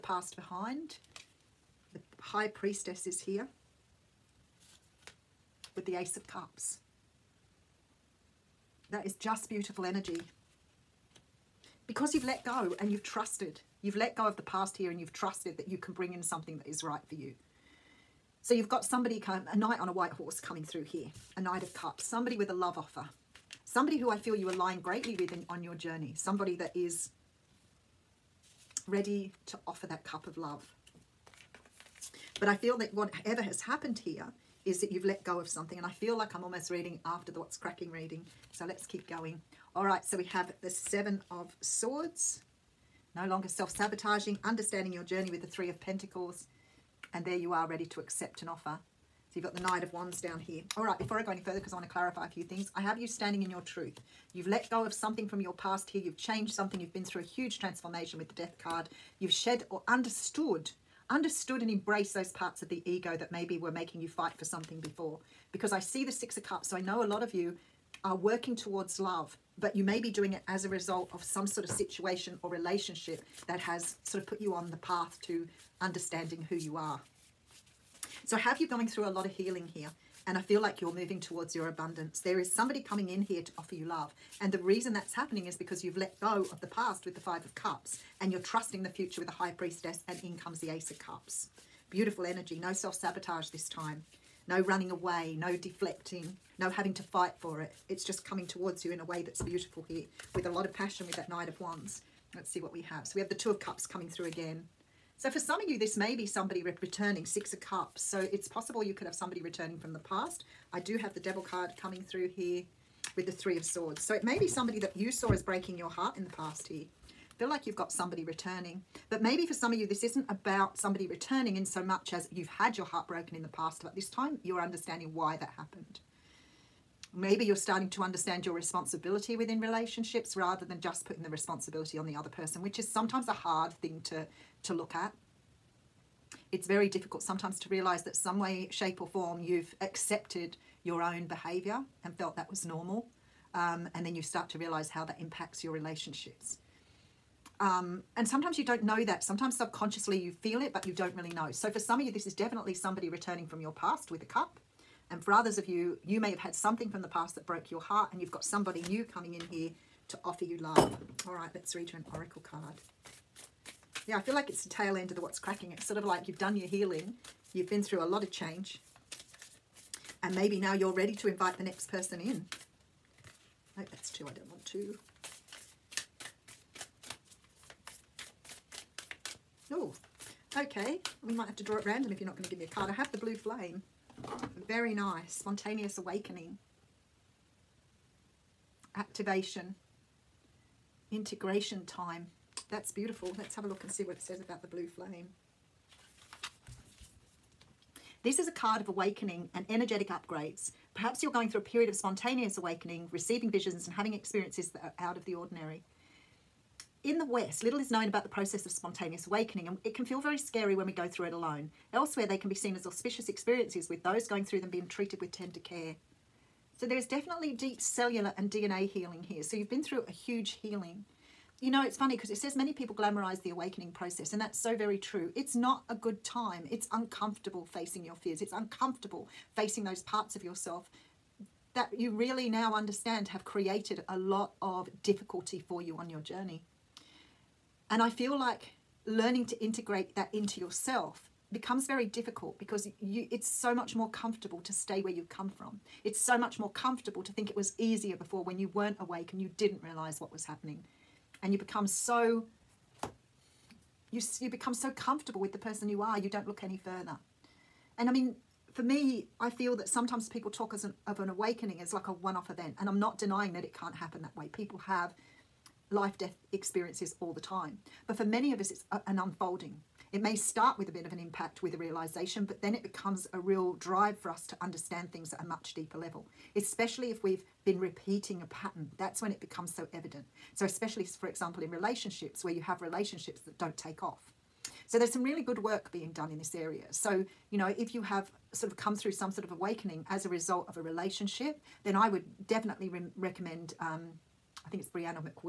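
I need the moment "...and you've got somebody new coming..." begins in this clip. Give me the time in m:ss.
2:38.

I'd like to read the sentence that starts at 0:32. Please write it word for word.
But I feel that whatever has happened here is that you've let go of something.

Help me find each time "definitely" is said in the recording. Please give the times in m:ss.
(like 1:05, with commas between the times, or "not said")
2:32, 3:37, 4:52.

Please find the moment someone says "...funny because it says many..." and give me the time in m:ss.
3:41.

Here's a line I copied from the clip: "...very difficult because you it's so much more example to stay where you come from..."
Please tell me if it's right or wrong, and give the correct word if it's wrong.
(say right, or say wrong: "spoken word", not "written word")
wrong: "comfortable", not "example".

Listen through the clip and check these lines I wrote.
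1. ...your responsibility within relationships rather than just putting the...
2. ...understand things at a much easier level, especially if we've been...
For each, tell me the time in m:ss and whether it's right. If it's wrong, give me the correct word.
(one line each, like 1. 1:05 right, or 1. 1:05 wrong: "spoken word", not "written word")
1. 2:08 right
2. 4:34 wrong: "deeper", not "easier".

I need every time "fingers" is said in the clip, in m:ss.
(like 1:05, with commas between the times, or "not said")
not said.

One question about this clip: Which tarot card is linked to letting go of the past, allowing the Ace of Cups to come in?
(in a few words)
Five of Cups.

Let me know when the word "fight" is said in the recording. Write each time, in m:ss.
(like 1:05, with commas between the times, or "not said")
1:04, 1:37.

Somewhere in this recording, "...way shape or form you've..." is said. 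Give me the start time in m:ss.
2:18.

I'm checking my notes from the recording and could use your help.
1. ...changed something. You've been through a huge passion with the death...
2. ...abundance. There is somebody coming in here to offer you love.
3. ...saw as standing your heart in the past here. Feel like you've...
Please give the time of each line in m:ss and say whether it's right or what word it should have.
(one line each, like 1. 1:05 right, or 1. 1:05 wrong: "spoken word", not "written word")
1. 0:56 wrong: "transformation", not "passion"
2. 1:21 right
3. 1:55 wrong: "breaking", not "standing".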